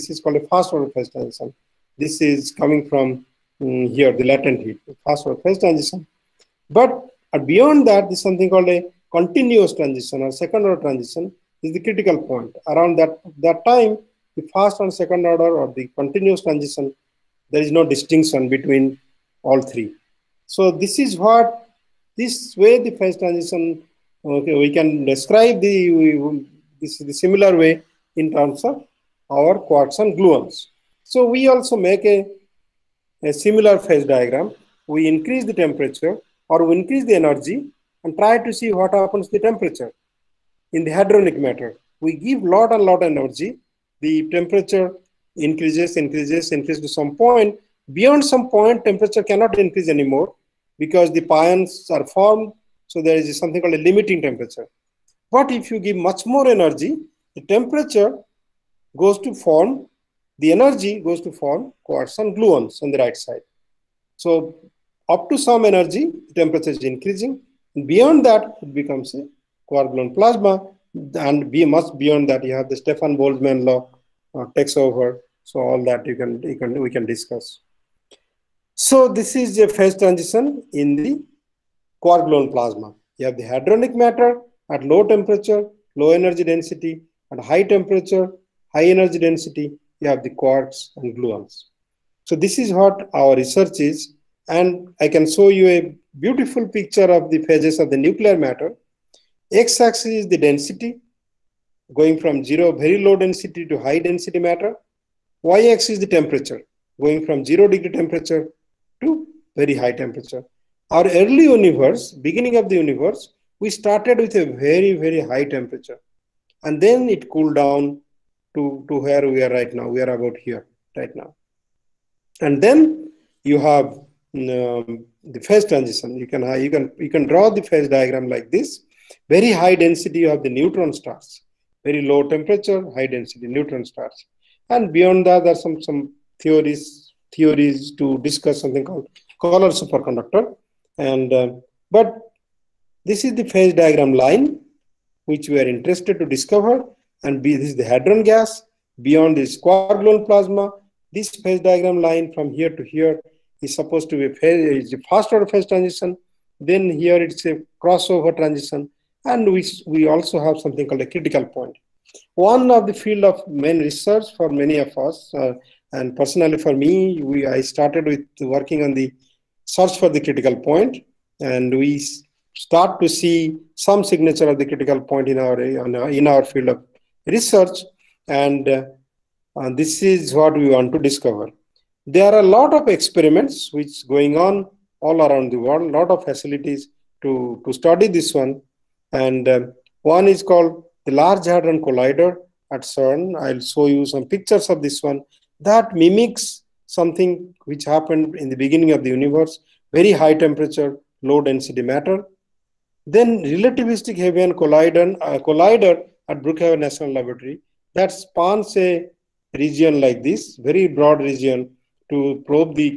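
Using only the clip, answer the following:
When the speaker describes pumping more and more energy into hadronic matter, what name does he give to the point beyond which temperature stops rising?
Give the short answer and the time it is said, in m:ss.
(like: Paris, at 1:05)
Limiting temperature, at 0:53.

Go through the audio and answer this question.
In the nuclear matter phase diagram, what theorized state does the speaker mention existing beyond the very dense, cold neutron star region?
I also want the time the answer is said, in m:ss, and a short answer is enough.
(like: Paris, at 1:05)
Color superconductor, at 2:19.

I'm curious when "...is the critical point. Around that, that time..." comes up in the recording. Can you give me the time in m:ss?
0:11.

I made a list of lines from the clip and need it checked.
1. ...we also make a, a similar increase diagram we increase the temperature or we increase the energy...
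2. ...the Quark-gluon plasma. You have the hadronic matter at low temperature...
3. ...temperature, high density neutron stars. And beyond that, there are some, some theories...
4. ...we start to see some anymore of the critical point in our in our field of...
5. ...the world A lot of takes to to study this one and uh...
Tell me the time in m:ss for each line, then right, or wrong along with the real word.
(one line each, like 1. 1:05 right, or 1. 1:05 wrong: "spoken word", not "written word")
1. 0:31 wrong: "phase", not "increase"
2. 1:20 right
3. 2:12 right
4. 2:51 wrong: "signature", not "anymore"
5. 3:05 wrong: "facilities", not "takes".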